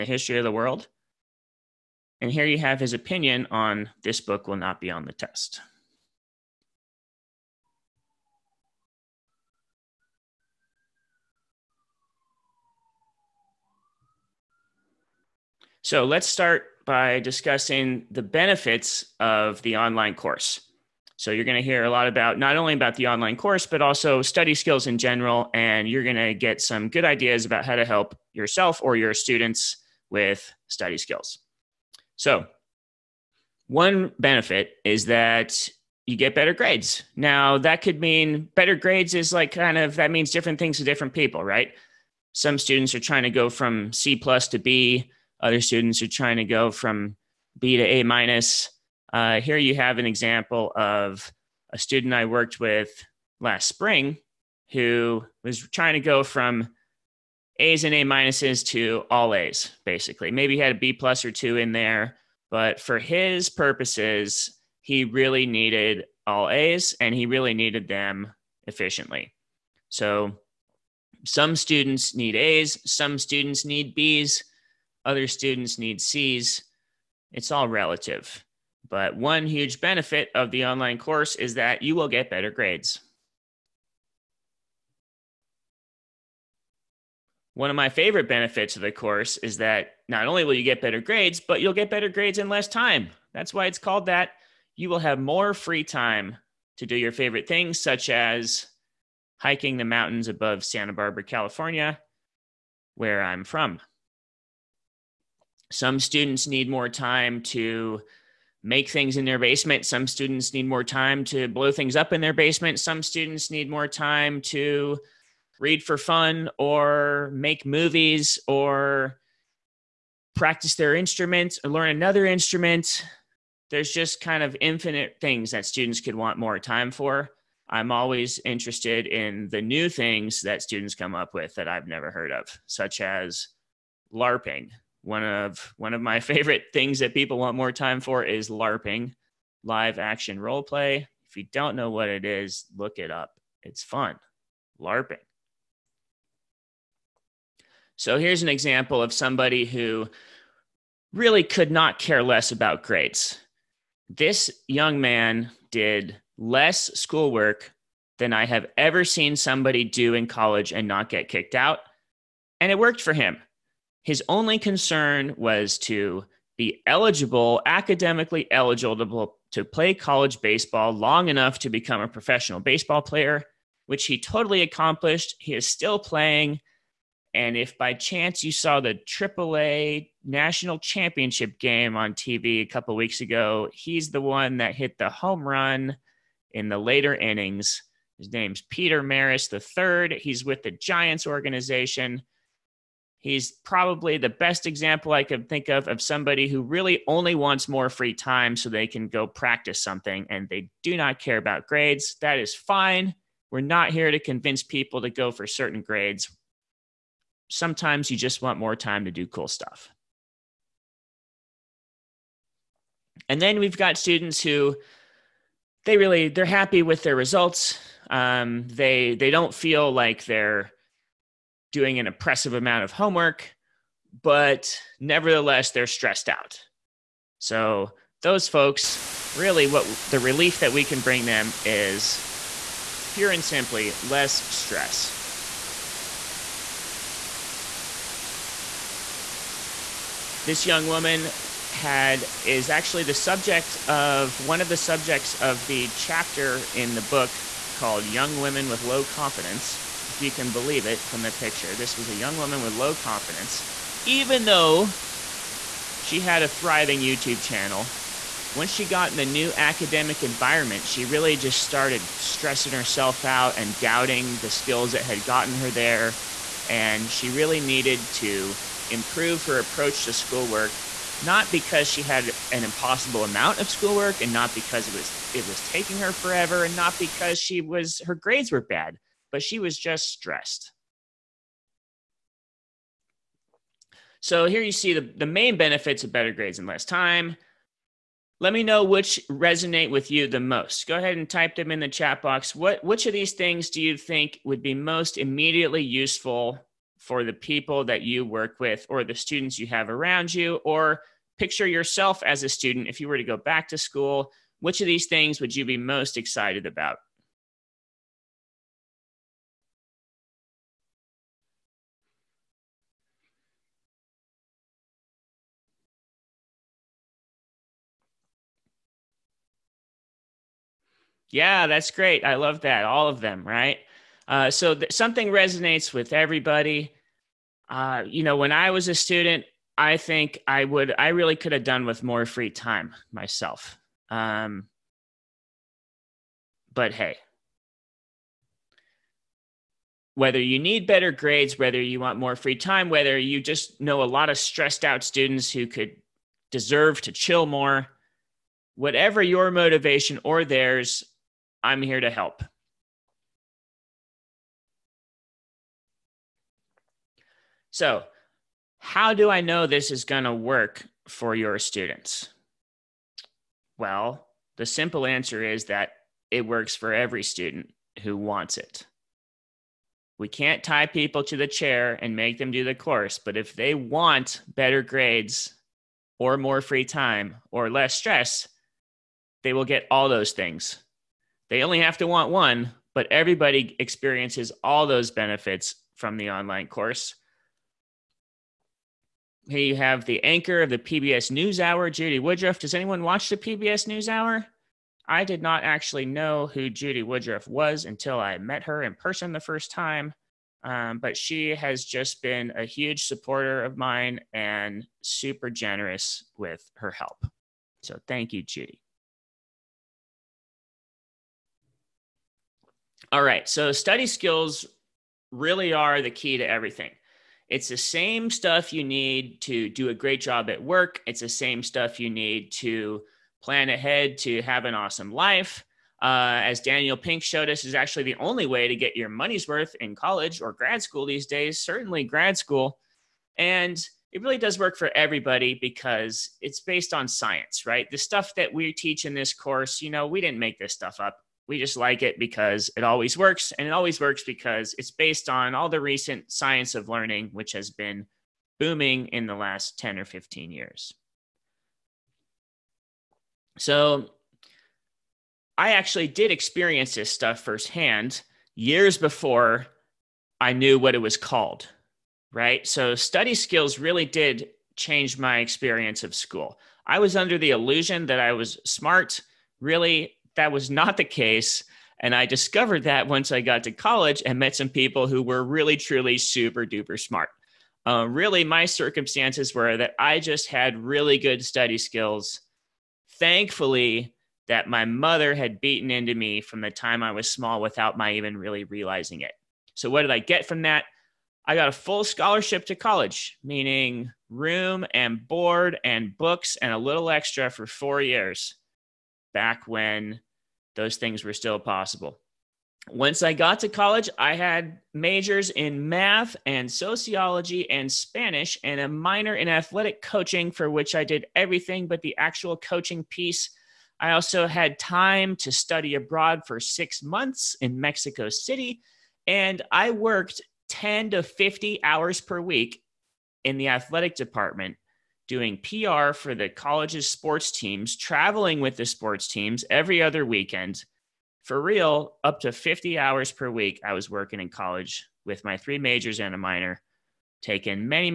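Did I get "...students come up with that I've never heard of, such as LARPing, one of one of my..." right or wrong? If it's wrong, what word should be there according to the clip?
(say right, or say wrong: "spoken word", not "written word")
right.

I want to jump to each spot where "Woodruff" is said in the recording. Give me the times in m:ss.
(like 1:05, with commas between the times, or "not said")
6:32, 6:37.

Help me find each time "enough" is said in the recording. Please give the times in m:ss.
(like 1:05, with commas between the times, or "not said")
2:51.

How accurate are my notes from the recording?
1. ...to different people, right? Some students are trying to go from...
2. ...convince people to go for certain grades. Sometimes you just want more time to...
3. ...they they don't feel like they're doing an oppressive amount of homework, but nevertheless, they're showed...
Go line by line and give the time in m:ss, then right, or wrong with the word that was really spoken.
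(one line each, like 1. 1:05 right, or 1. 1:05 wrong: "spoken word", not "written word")
1. 0:40 right
2. 3:24 right
3. 3:38 wrong: "stressed", not "showed".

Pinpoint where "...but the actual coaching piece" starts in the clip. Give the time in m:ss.
8:31.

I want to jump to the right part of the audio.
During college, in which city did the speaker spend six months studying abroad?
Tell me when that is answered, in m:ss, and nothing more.
8:37.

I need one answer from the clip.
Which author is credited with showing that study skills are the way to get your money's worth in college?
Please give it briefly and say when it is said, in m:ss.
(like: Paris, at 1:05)
Daniel Pink, at 7:06.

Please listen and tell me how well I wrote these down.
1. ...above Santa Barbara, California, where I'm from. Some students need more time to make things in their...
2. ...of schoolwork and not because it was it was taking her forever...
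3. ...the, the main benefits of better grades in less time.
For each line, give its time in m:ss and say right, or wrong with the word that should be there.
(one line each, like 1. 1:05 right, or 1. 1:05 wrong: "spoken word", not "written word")
1. 1:40 right
2. 4:33 right
3. 4:44 right.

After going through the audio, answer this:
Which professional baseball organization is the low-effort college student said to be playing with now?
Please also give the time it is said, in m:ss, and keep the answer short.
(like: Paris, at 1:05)
Giants, at 3:10.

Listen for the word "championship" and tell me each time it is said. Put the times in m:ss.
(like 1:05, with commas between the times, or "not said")
3:00.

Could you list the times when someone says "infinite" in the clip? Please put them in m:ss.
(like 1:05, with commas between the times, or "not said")
2:04.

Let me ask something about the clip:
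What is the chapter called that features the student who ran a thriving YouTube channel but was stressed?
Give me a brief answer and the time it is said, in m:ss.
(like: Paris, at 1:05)
Young Women with Low Confidence, at 4:08.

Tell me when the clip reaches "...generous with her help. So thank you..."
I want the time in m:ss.
6:45.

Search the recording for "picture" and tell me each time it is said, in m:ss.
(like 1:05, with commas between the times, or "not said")
4:11, 5:01.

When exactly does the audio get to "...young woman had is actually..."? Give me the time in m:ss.
4:00.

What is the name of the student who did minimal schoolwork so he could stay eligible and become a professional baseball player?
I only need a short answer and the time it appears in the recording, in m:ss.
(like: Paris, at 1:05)
Peter Maris III, at 3:08.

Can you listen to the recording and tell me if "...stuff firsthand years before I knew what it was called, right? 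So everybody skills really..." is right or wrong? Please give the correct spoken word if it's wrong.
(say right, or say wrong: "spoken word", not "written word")
wrong: "study", not "everybody".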